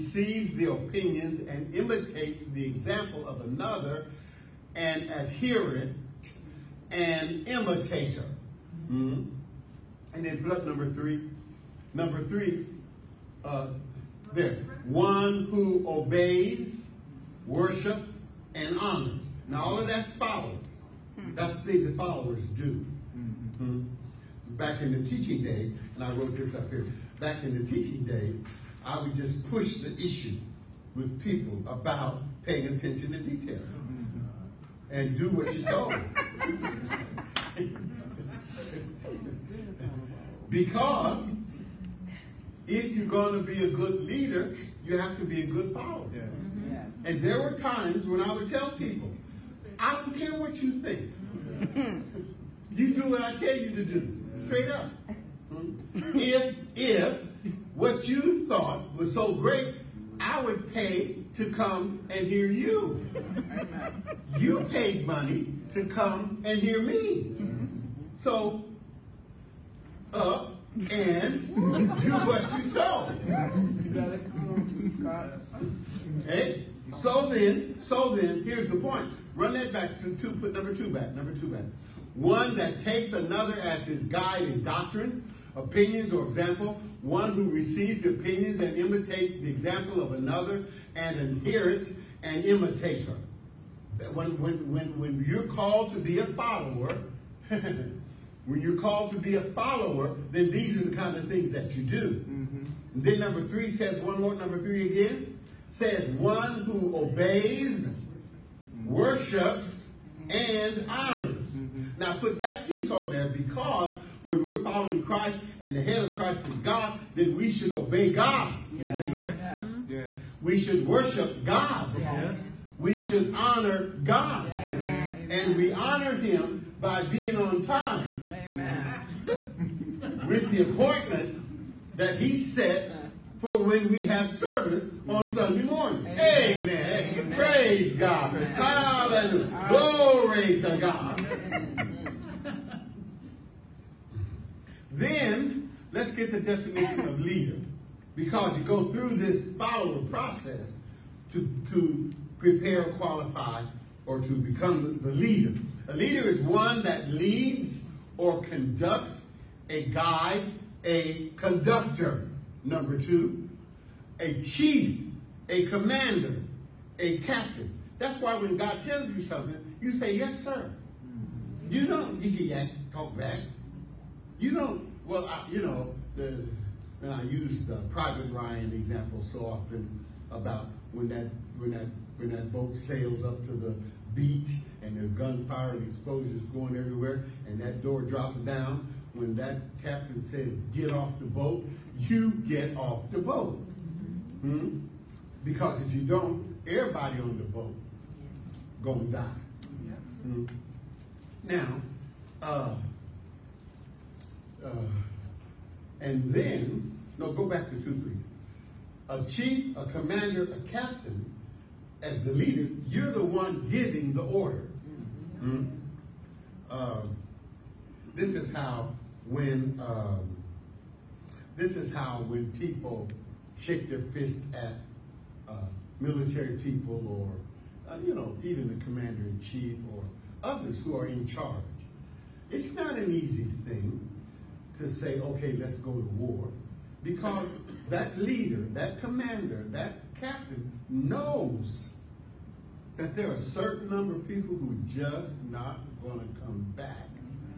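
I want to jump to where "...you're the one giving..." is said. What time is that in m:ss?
3:32.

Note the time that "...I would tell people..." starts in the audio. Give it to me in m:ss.
0:48.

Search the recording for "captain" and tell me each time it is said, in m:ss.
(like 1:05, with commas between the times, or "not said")
2:47, 3:09, 3:30, 4:00.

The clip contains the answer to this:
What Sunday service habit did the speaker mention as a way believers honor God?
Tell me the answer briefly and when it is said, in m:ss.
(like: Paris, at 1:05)
Being on time, at 2:07.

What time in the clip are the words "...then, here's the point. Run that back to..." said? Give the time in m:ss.
1:18.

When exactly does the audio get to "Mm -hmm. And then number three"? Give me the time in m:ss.
0:08.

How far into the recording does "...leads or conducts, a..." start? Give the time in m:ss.
2:37.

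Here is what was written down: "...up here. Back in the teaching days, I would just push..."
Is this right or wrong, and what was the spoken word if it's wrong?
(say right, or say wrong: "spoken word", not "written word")
right.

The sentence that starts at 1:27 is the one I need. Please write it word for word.
One who receives opinions and imitates the example of another and inherits an imitator.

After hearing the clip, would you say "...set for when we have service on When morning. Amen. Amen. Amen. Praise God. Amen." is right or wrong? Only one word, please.
wrong.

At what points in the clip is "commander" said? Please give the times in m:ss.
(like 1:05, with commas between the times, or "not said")
2:45, 3:29, 3:48, 3:58.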